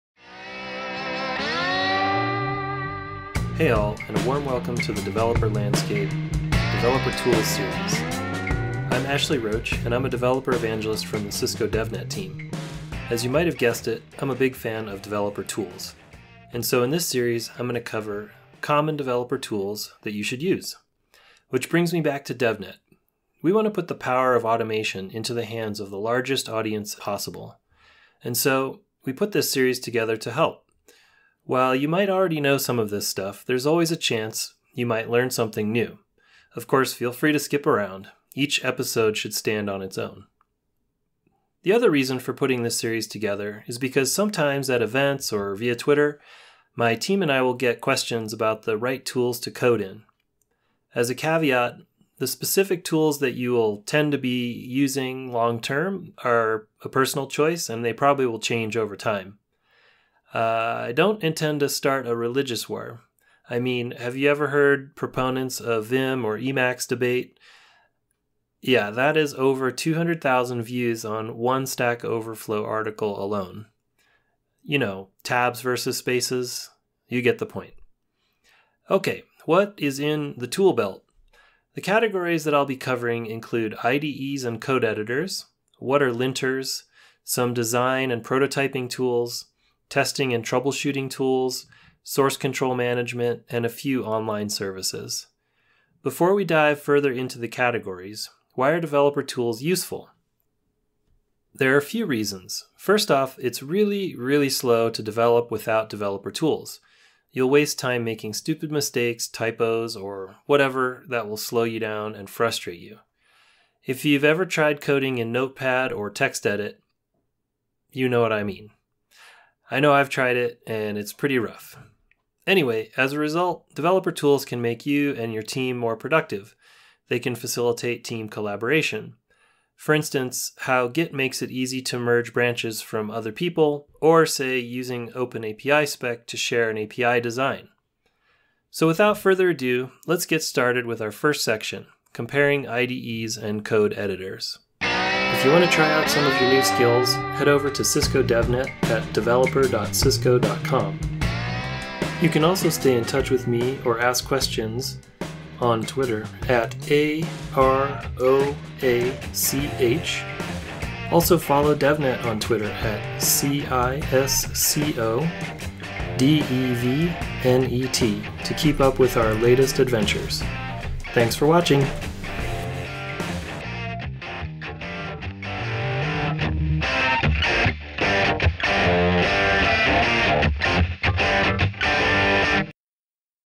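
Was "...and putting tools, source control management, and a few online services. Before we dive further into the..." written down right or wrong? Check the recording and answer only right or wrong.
wrong.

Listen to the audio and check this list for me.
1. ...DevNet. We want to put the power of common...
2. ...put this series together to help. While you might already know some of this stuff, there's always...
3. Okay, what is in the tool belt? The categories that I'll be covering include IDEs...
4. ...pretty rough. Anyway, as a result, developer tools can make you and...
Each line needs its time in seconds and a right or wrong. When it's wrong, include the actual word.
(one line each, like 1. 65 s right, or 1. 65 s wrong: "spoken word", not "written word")
1. 22 s wrong: "automation", not "common"
2. 29 s right
3. 78 s right
4. 121 s right.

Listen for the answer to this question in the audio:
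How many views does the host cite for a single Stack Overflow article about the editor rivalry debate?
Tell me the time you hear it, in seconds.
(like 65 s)
69 s.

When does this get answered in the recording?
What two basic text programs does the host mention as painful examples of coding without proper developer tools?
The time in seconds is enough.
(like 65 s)
115 s.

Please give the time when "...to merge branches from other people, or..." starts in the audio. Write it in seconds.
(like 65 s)
131 s.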